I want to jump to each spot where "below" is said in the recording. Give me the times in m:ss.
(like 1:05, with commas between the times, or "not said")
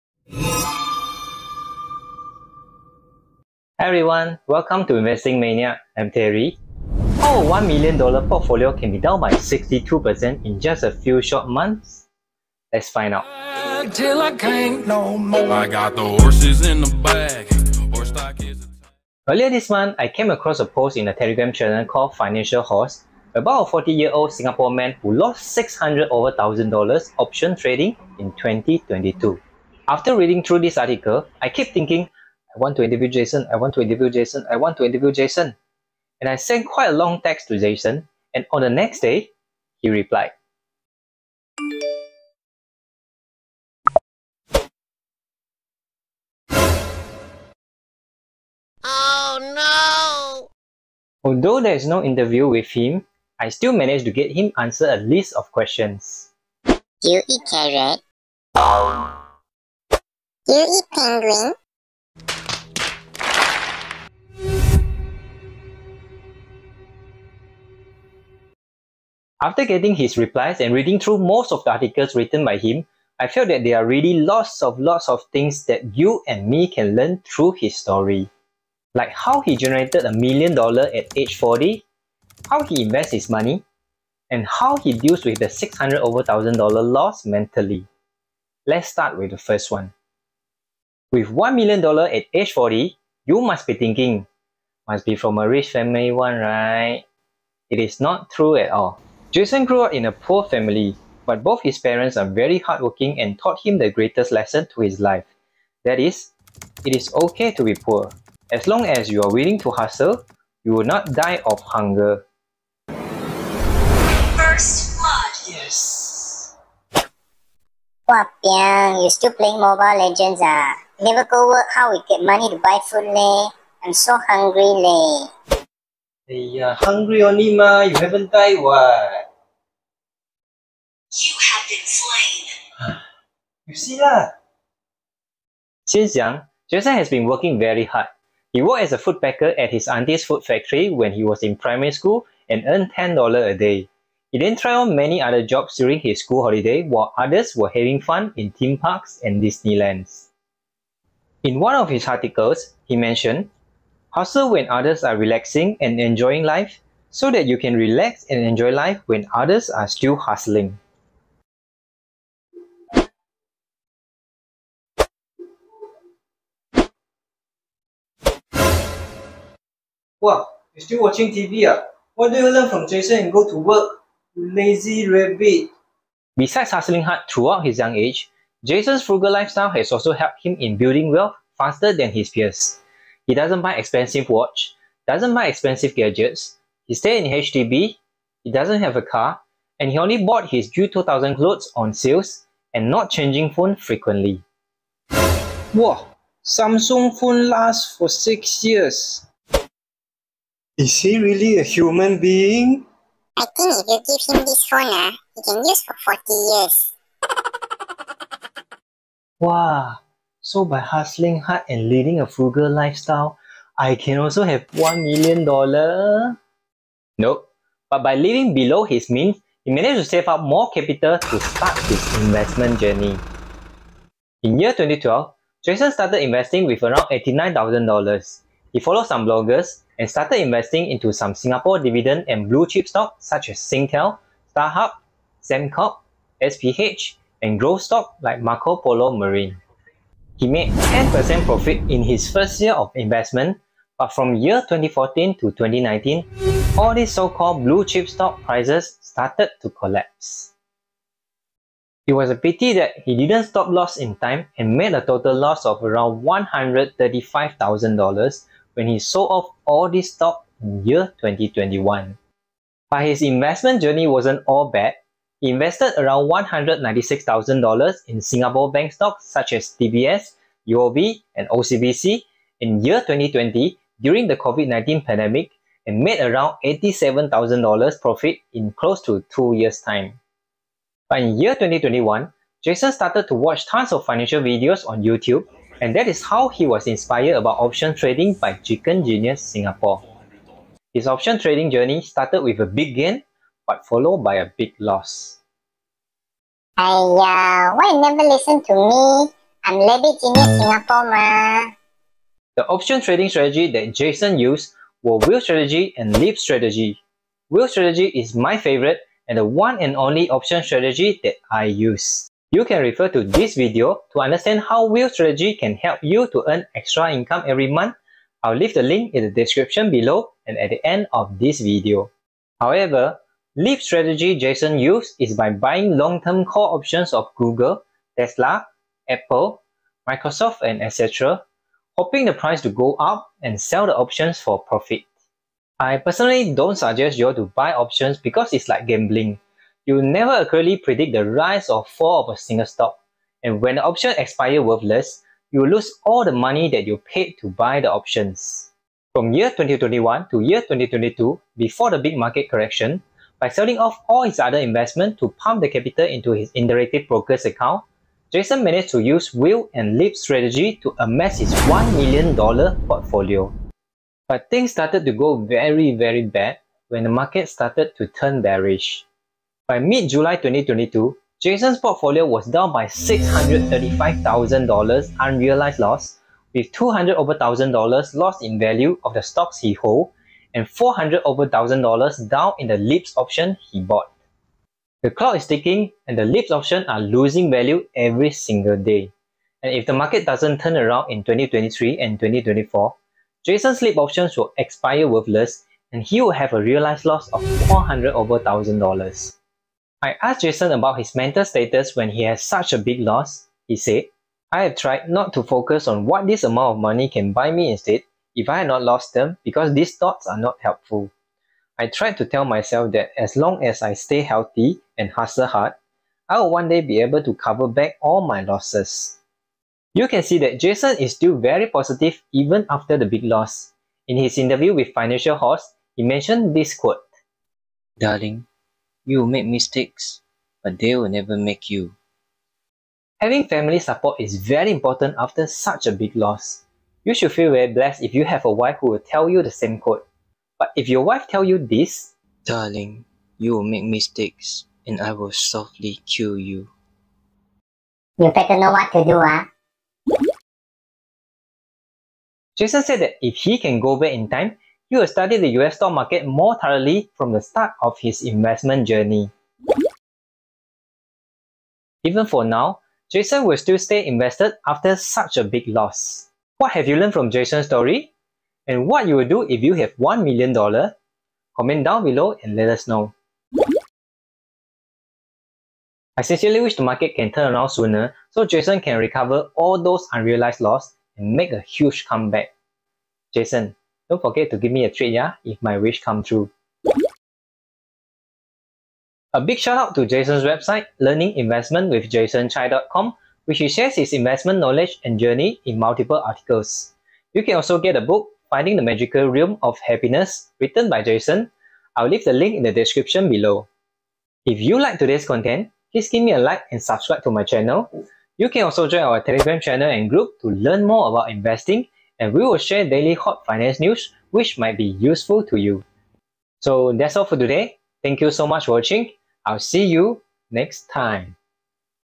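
3:38, 5:19, 7:52, 8:23.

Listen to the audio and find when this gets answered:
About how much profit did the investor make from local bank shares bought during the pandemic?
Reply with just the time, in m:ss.
4:36.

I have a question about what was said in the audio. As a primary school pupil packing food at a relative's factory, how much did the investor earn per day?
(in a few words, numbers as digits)
$10.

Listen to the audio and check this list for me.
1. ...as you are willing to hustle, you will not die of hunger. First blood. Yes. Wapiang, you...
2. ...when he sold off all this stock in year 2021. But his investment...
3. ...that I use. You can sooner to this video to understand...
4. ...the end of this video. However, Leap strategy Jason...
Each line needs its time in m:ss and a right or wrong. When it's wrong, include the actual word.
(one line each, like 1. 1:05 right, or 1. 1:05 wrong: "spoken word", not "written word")
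1. 1:48 right
2. 4:18 right
3. 5:11 wrong: "refer", not "sooner"
4. 5:20 right.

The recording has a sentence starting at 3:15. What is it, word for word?
Wow, Samsung phone lasts for 6 years.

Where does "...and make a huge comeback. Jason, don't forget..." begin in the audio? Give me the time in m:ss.
8:01.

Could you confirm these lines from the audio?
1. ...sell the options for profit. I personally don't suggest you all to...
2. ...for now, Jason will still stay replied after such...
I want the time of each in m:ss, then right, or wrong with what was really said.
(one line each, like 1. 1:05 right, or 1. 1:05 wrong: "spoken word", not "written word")
1. 5:33 right
2. 7:42 wrong: "invested", not "replied".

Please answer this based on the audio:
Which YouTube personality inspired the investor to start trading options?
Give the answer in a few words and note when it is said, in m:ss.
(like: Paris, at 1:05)
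Chicken Genius Singapore, at 4:48.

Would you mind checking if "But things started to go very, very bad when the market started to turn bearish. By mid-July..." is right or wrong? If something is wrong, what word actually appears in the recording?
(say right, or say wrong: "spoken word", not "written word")
right.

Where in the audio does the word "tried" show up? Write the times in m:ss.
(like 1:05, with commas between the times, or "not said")
2:24, 6:44, 6:51.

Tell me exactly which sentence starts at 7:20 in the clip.
But if your wife tell you this, Darling, you will make mistakes and I will softly kill you.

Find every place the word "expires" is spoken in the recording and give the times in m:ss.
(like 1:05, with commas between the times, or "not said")
5:44, 6:34.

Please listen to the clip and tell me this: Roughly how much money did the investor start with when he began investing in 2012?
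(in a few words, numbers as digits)
$89,000.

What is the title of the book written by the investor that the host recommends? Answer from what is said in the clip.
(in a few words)
Finding the Magical Realm of Happiness.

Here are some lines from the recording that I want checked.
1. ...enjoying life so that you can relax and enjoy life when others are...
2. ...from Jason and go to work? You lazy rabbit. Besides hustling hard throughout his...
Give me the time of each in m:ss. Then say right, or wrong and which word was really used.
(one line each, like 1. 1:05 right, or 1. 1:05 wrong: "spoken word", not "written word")
1. 2:35 right
2. 2:52 right.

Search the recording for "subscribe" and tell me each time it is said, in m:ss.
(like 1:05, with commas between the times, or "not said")
8:26.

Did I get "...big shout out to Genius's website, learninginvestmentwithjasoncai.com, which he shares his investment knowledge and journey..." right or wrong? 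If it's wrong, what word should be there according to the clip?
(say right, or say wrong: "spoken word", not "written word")
wrong: "Jason", not "Genius".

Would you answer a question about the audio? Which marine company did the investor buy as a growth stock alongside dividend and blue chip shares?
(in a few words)
Marco Polo Marine.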